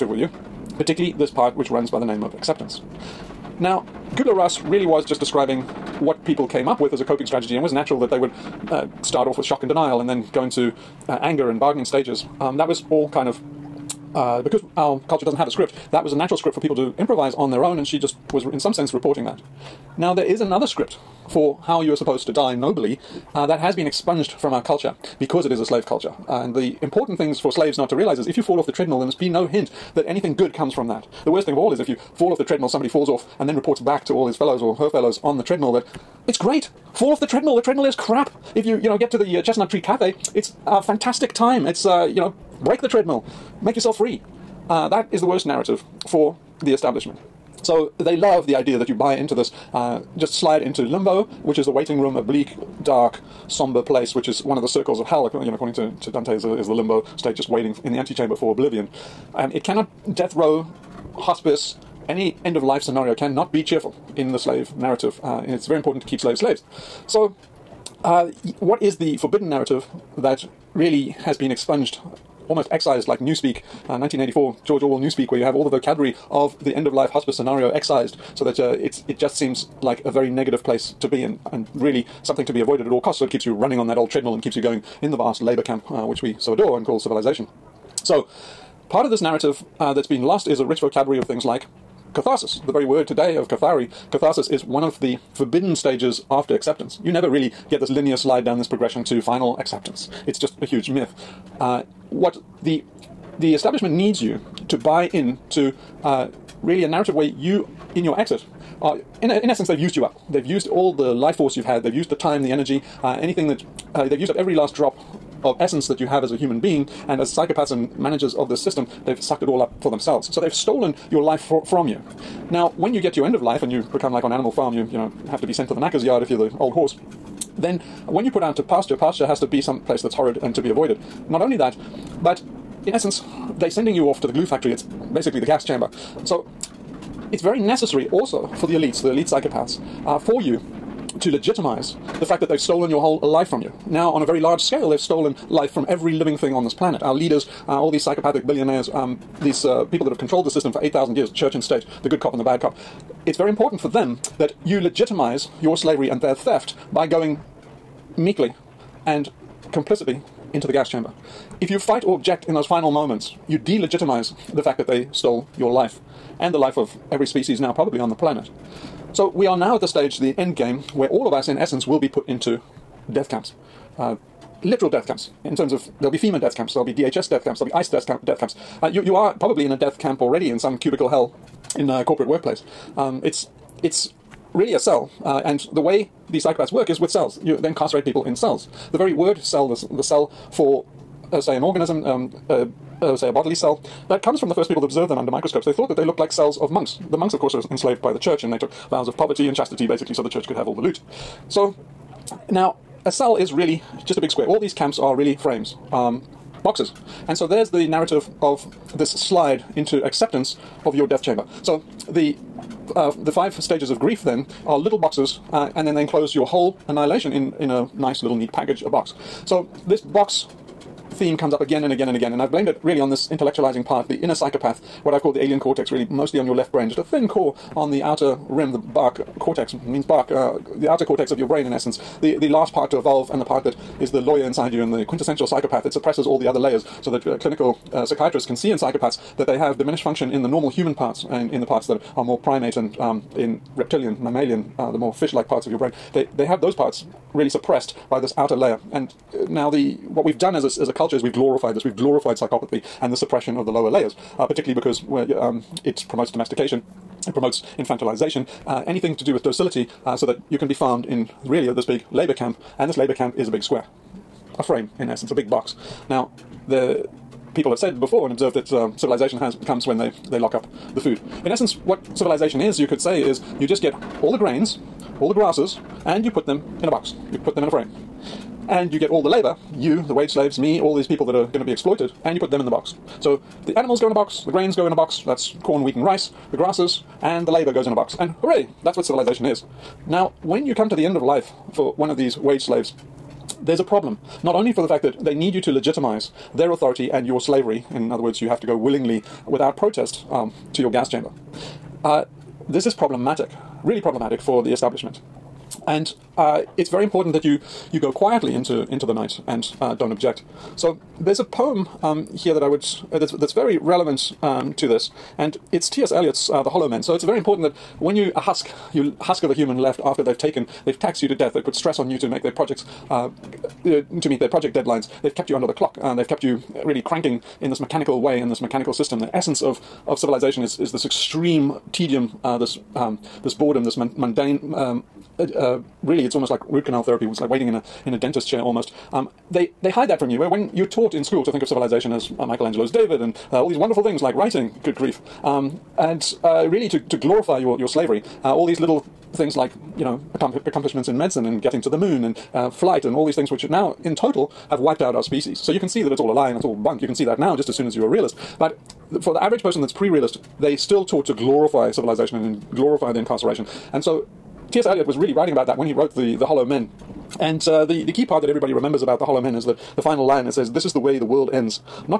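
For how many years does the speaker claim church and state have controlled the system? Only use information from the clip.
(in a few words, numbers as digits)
8,000.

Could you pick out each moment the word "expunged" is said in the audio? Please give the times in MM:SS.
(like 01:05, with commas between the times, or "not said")
00:23, 01:11.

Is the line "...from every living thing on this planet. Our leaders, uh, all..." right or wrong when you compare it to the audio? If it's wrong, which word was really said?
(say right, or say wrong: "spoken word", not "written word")
right.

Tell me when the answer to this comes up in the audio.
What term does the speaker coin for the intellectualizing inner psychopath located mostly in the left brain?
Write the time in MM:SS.
03:45.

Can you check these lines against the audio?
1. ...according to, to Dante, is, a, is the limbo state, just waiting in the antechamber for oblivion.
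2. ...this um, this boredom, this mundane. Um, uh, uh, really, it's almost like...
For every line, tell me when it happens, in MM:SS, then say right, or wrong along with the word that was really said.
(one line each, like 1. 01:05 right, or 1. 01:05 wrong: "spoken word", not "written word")
1. 00:55 right
2. 05:32 right.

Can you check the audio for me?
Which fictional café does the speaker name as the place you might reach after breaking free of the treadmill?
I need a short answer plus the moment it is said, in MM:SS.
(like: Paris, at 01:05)
Chestnut Tree Cafe, at 00:39.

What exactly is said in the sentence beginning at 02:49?
So we are now at the stage, the end game, where all of us, in essence, will be put into death camps.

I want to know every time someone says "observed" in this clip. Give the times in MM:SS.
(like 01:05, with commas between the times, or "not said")
03:14, 04:28.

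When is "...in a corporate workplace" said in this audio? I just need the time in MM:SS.
03:01.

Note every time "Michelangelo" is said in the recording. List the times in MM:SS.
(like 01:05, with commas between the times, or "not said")
05:42.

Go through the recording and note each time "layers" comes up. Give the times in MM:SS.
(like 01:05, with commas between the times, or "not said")
03:56, 04:08, 04:13.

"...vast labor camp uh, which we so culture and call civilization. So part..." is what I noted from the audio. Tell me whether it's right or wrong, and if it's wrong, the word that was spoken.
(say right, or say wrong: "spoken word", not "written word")
wrong: "adore", not "culture".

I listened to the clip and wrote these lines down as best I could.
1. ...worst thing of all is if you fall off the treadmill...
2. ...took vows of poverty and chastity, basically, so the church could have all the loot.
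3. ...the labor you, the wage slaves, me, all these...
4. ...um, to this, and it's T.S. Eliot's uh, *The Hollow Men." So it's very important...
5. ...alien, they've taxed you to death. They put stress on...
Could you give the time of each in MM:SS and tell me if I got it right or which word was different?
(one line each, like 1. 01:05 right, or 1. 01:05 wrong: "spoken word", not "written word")
1. 00:31 right
2. 03:18 right
3. 04:39 right
4. 05:14 right
5. 05:20 wrong: "taken", not "alien".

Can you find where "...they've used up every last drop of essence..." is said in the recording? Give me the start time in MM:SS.
01:54.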